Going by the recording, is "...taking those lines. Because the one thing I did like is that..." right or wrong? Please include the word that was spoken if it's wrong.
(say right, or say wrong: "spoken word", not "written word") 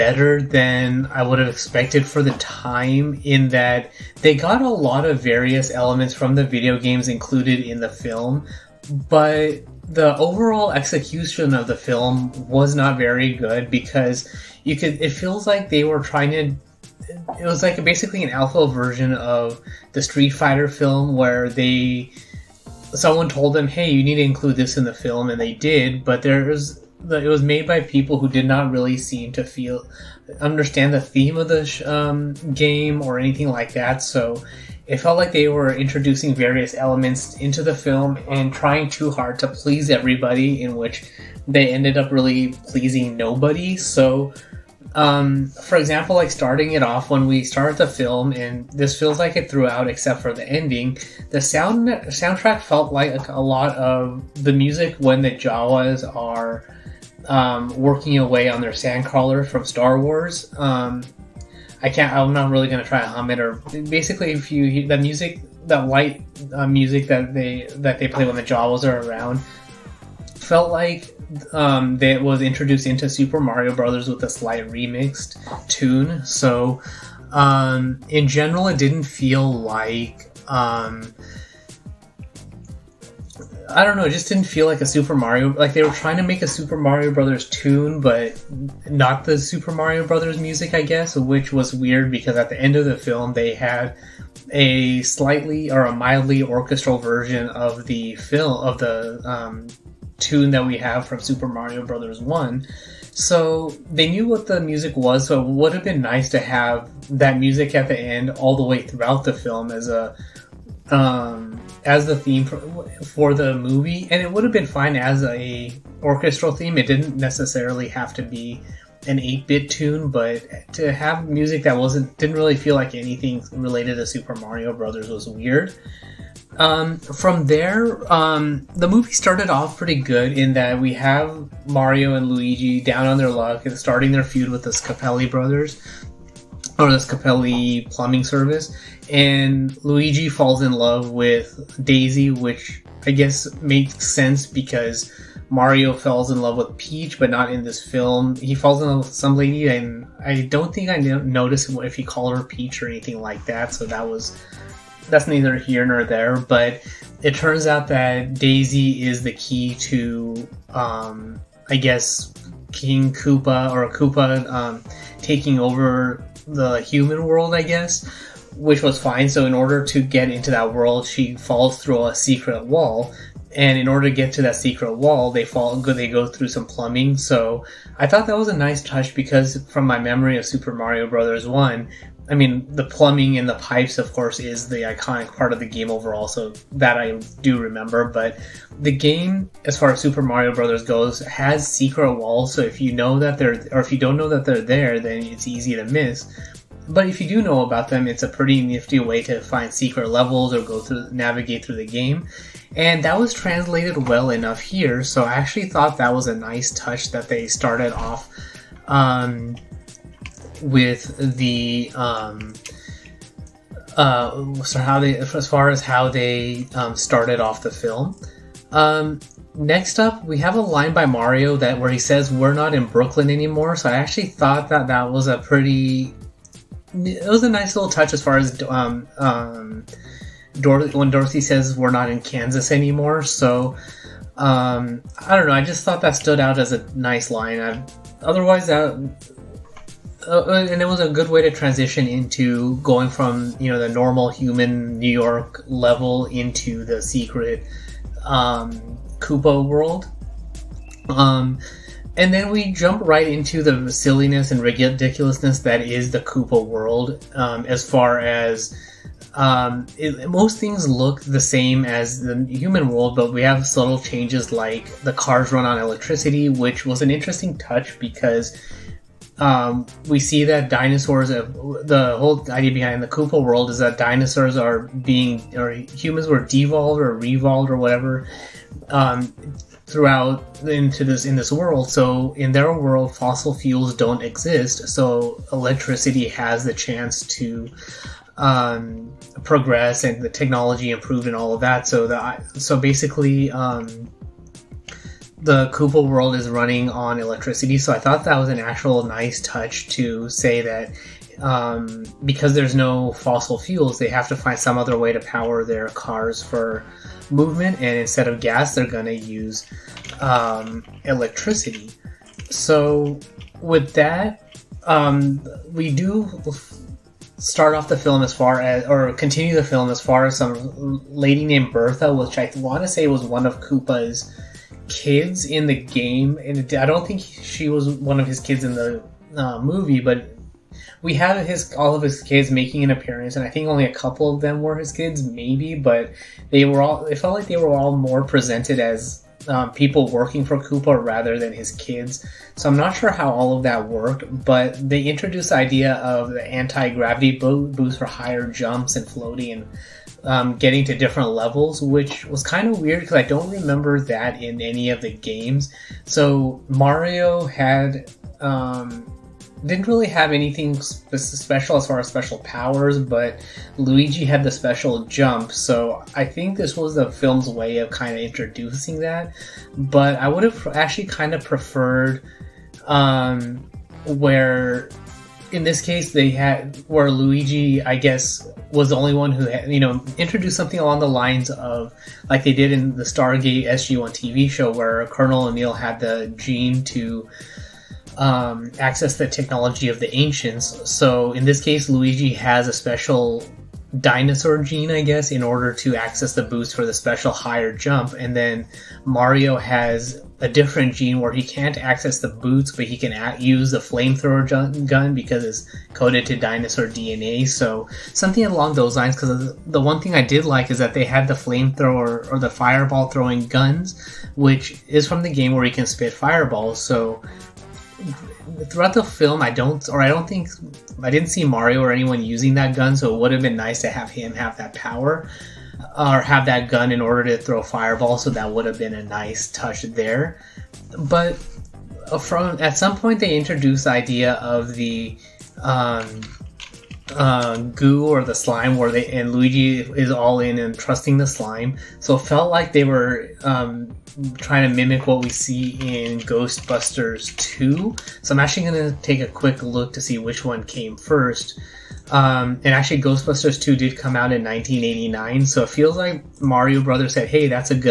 wrong: "along", not "taking".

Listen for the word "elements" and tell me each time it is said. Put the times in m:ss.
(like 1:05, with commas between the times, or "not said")
0:05, 0:36.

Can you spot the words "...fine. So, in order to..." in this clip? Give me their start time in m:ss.
2:49.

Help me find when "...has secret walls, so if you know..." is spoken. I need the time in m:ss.
3:11.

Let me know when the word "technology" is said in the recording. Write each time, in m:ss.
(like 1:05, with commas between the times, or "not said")
4:50, 6:29.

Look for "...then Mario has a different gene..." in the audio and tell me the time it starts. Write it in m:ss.
6:38.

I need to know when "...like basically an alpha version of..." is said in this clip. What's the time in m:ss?
0:17.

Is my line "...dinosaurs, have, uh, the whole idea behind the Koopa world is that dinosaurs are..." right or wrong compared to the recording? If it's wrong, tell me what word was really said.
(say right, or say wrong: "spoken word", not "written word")
right.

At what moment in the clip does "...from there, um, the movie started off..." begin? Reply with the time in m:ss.
2:06.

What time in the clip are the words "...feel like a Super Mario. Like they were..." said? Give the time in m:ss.
1:24.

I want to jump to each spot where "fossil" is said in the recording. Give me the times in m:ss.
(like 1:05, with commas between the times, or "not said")
4:43, 5:03.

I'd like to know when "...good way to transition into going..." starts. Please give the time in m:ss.
4:01.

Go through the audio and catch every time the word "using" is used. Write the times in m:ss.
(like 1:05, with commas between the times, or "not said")
7:02.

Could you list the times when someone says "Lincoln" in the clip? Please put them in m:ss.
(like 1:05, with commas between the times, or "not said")
not said.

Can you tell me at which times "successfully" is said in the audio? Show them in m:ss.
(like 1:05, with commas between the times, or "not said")
not said.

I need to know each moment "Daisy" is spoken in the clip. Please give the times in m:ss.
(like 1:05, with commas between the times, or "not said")
2:21, 2:38.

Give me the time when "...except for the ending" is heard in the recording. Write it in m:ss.
0:49.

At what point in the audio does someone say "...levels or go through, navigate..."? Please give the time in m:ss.
3:20.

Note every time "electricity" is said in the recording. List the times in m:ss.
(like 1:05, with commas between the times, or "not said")
4:25, 4:45, 4:57, 5:11.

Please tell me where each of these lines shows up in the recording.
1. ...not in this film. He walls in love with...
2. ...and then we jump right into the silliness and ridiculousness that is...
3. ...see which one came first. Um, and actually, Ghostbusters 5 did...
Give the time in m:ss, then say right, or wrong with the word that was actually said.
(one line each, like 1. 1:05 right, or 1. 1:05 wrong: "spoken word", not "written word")
1. 2:27 wrong: "falls", not "walls"
2. 4:12 right
3. 7:30 wrong: "2", not "5".